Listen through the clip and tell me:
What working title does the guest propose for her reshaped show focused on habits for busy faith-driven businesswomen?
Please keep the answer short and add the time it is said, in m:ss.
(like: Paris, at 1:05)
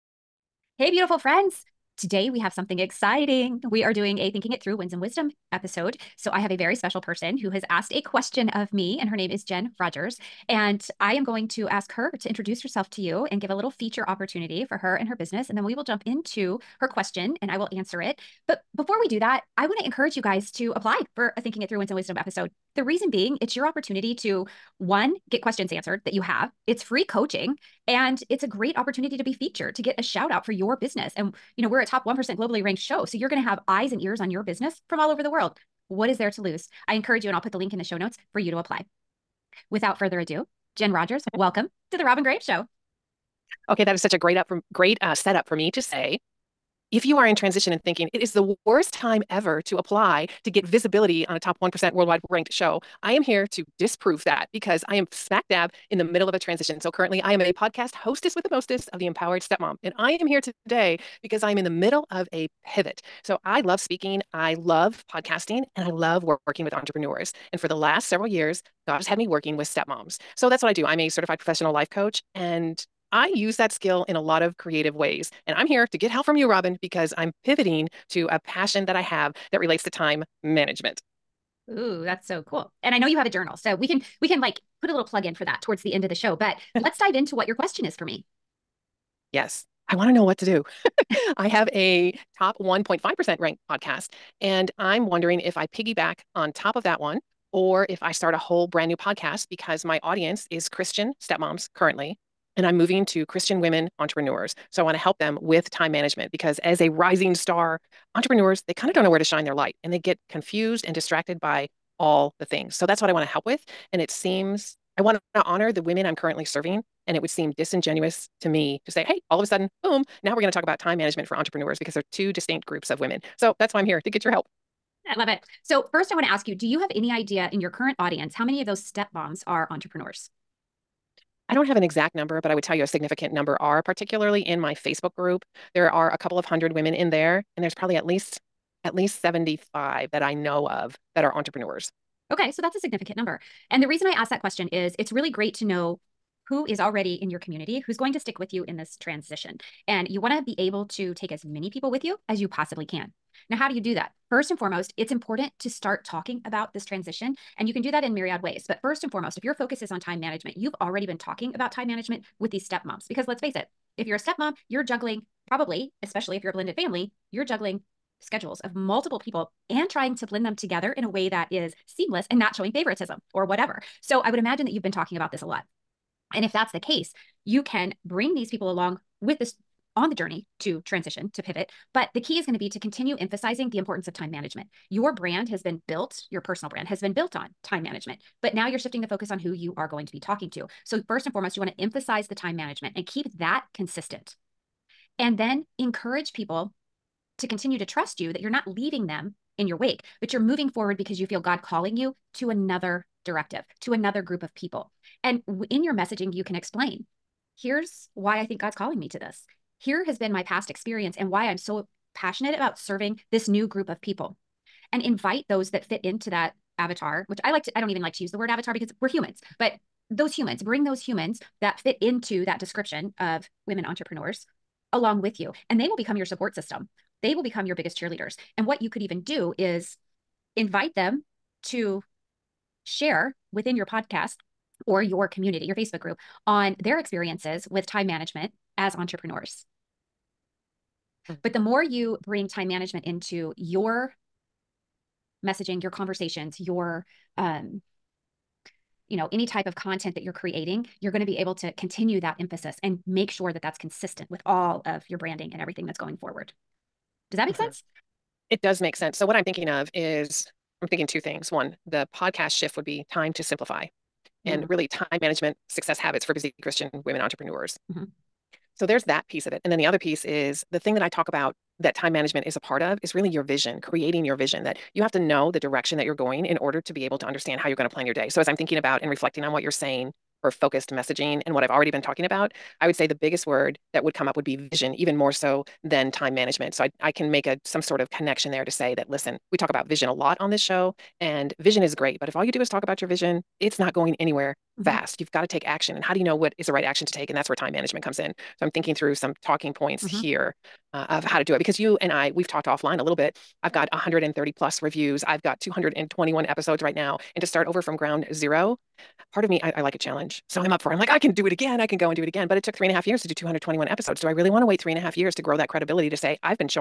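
Time to Simplify, at 4:23.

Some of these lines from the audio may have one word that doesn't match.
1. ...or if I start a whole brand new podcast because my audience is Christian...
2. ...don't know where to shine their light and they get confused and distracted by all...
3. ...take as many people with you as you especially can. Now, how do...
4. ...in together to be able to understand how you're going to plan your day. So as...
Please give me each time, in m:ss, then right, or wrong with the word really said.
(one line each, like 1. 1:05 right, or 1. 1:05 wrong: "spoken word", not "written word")
1. 1:37 right
2. 1:48 right
3. 2:31 wrong: "possibly", not "especially"
4. 4:36 wrong: "order", not "together".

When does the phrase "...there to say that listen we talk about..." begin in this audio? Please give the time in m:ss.
4:48.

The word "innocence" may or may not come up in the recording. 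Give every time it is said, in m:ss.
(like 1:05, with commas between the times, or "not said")
not said.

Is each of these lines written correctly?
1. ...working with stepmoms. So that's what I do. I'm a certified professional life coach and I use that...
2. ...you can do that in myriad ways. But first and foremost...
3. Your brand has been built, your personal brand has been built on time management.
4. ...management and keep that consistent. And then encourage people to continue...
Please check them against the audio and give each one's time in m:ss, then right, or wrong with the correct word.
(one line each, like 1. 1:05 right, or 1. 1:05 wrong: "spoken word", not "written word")
1. 1:09 right
2. 2:37 right
3. 3:04 right
4. 3:12 right.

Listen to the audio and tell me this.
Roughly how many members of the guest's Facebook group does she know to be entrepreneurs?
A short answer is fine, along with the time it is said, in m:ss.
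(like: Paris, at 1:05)
75, at 2:19.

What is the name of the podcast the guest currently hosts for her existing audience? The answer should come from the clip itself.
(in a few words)
The Empowered Stepmom.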